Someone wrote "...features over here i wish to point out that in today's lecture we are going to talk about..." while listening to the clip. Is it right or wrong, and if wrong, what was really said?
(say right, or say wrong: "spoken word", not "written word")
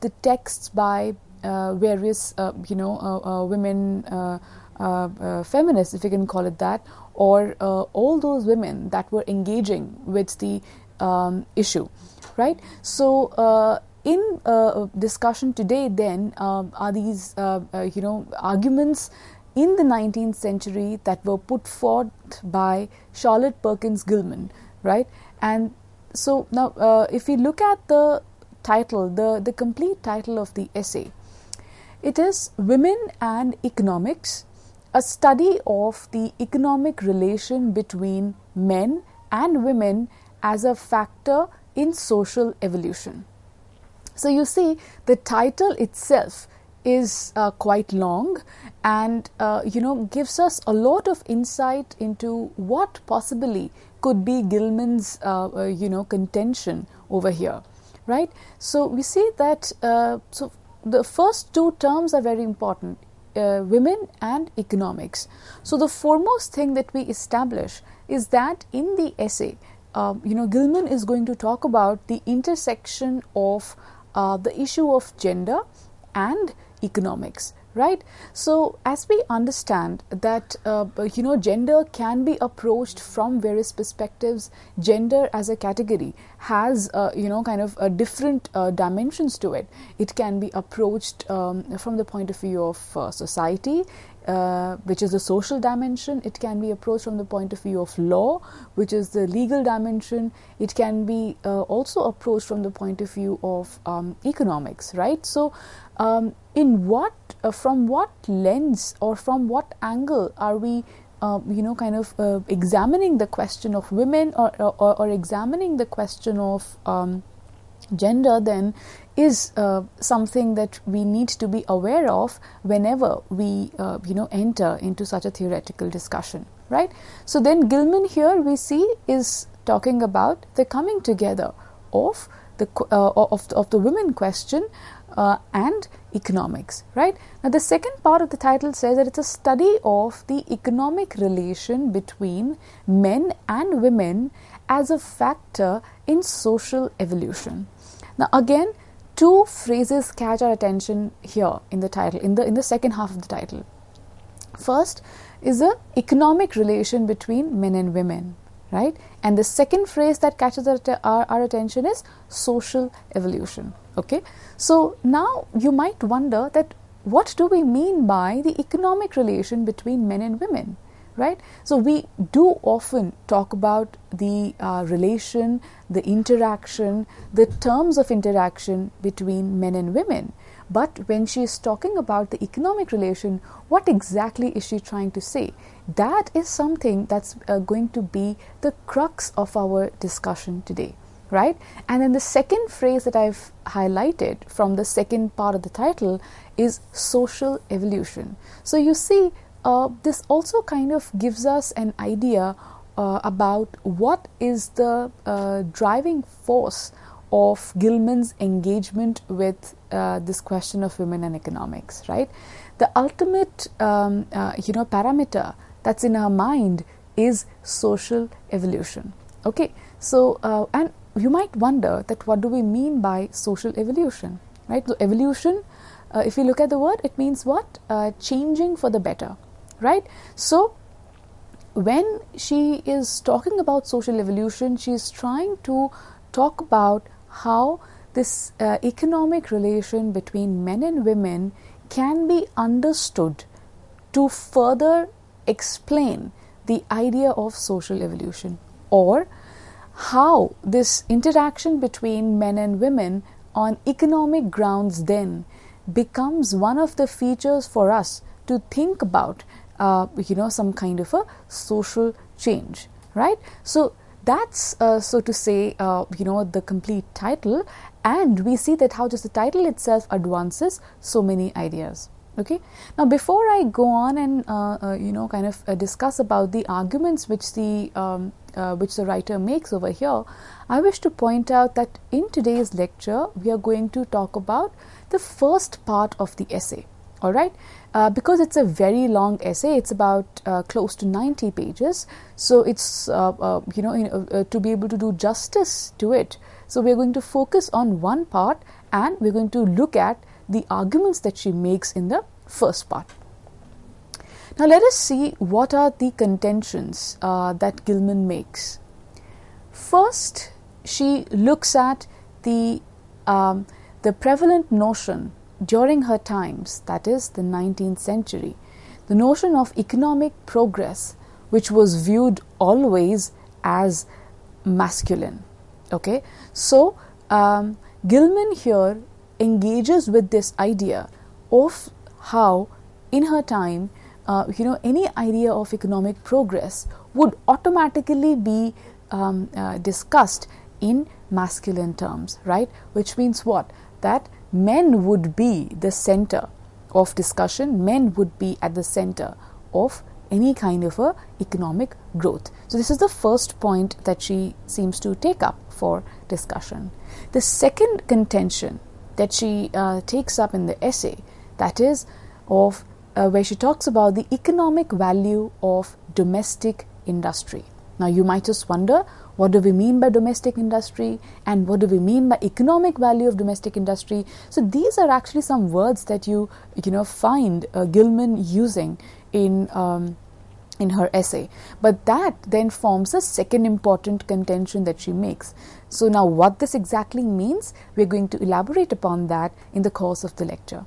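wrong: "makes", not "features".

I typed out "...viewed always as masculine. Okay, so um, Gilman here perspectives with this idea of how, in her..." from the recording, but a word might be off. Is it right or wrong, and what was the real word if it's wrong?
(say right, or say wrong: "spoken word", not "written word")
wrong: "engages", not "perspectives".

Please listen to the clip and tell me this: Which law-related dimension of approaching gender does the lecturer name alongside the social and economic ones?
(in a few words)
legal dimension.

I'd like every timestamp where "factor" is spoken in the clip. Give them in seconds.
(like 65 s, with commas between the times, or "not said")
40 s, 144 s.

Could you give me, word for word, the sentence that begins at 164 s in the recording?
So, now you might wonder that what do we mean by the economic relation between men and women?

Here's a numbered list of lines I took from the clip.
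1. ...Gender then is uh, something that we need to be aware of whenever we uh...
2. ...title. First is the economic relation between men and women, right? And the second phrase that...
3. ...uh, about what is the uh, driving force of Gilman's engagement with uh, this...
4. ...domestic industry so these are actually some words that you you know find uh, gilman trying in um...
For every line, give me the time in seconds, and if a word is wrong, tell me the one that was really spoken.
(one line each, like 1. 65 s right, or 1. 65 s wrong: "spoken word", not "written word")
1. 117 s right
2. 153 s right
3. 202 s right
4. 373 s wrong: "using", not "trying".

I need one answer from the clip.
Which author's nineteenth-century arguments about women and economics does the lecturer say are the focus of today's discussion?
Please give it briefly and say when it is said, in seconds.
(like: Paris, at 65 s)
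Charlotte Perkins Gilman, at 23 s.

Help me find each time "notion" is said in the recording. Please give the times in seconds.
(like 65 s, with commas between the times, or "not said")
314 s, 319 s.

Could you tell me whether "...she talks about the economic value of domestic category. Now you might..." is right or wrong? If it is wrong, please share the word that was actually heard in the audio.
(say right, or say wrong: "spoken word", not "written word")
wrong: "industry", not "category".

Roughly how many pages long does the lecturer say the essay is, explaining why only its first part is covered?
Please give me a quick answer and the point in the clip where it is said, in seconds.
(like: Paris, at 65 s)
90, at 291 s.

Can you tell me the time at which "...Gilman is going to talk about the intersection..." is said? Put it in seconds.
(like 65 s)
70 s.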